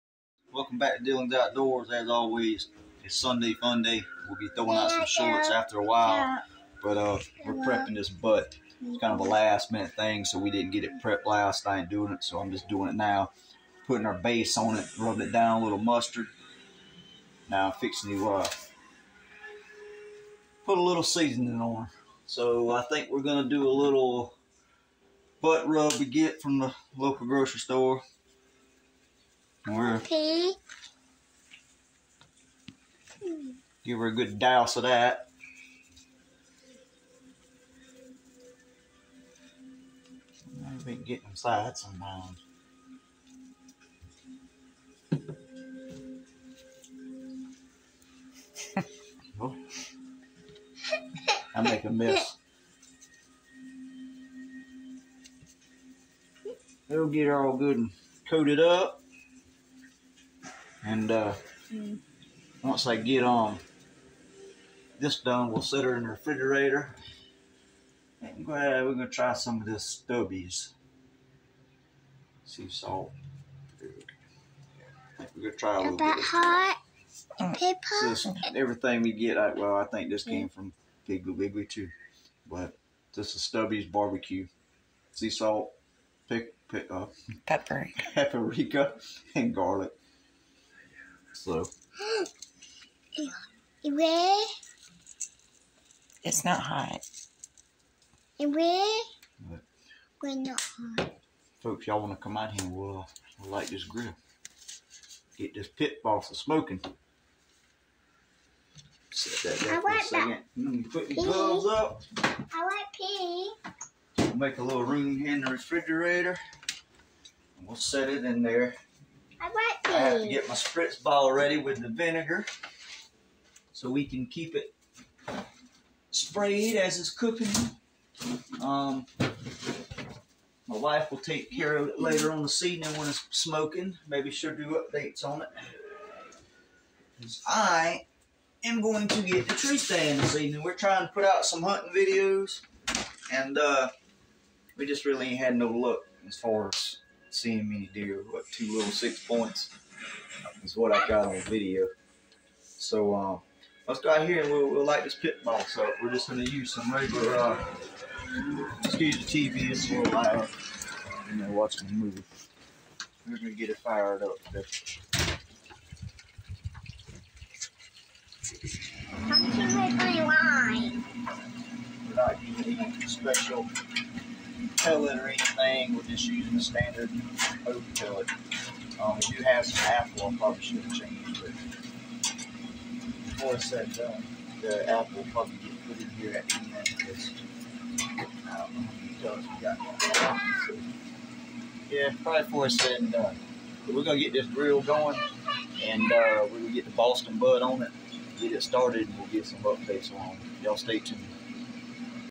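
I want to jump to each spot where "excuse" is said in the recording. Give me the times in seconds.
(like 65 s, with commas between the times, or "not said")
158 s.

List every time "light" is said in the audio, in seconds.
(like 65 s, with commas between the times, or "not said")
103 s, 154 s.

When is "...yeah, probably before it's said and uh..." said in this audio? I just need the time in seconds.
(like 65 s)
191 s.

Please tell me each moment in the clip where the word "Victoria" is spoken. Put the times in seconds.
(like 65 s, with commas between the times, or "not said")
not said.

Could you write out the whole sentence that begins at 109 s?
Set that there for a second.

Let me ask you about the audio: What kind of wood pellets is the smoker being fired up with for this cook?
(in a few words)
Oak.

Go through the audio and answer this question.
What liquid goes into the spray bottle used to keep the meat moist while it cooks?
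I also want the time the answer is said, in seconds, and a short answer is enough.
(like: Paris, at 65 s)
Vinegar, at 121 s.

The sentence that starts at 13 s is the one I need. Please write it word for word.
Putting our base on it, rubbing it down a little mustard.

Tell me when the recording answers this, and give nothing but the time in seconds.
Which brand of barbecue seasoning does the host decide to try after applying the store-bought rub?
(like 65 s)
83 s.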